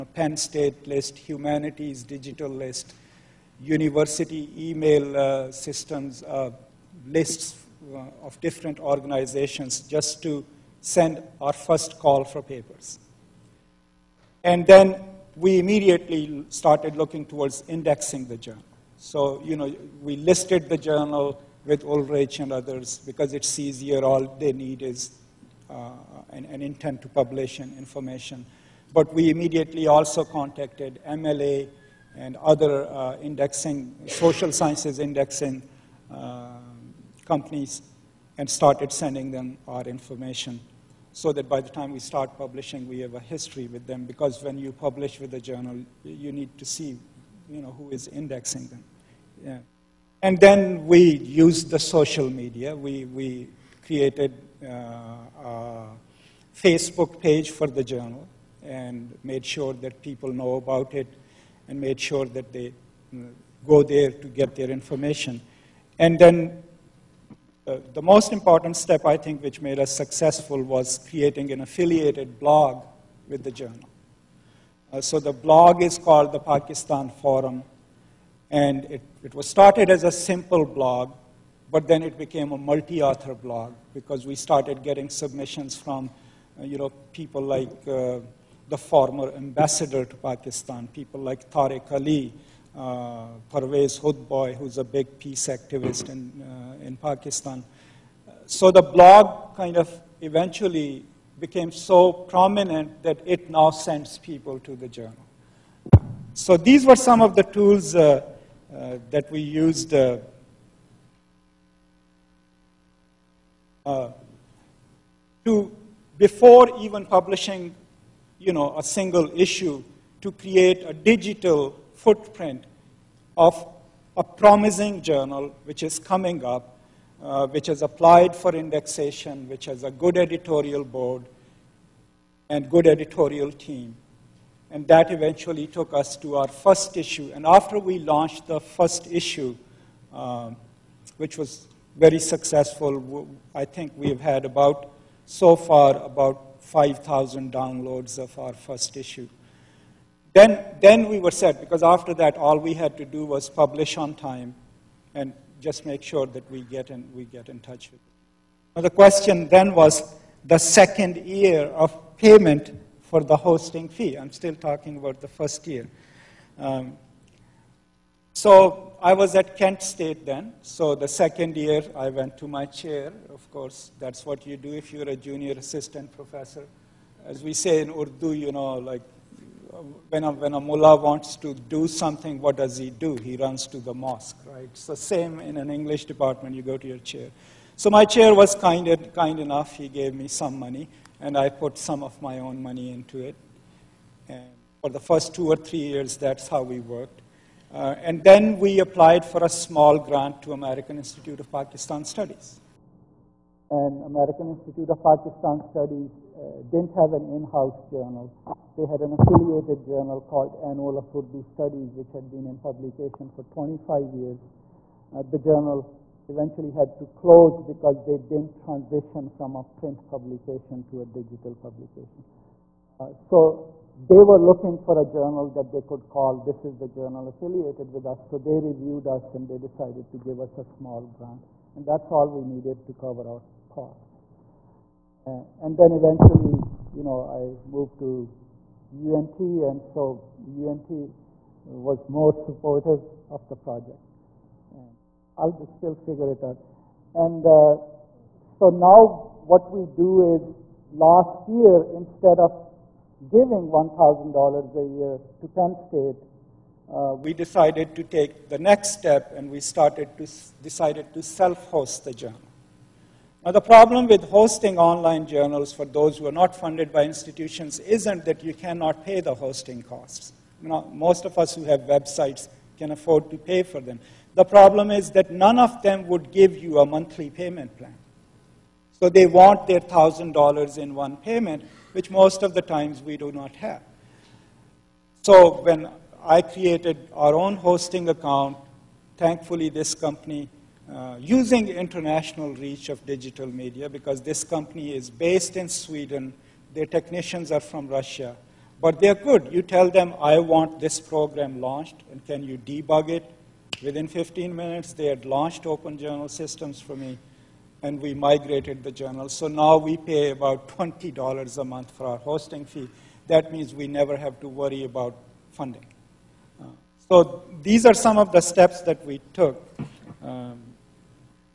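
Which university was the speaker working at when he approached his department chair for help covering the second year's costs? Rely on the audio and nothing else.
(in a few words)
Kent State.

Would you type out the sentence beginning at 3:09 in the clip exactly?
He gave me some money and I put some of my own money into it.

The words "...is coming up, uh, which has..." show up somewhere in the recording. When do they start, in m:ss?
2:05.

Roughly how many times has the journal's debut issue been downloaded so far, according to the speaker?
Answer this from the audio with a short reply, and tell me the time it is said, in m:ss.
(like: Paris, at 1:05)
5,000, at 2:26.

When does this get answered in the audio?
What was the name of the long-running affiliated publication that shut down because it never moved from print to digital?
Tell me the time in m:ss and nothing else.
3:30.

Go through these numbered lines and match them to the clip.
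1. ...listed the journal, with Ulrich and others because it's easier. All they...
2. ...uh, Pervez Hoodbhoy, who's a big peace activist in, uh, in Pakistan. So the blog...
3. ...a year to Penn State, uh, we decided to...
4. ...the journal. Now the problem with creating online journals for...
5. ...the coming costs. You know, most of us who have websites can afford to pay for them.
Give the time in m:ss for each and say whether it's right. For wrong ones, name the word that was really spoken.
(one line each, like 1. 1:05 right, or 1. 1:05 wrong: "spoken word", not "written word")
1. 0:20 right
2. 1:32 right
3. 4:14 right
4. 4:22 wrong: "hosting", not "creating"
5. 4:29 wrong: "hosting", not "coming".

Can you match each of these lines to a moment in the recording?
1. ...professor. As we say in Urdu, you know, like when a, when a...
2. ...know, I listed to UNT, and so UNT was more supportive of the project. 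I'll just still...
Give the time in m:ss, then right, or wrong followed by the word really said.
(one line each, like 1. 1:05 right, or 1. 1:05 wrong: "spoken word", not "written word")
1. 2:56 right
2. 3:57 wrong: "moved", not "listed".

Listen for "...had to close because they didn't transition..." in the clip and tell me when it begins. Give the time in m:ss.
3:36.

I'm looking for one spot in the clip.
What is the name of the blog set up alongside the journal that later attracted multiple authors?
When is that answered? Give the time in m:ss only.
1:16.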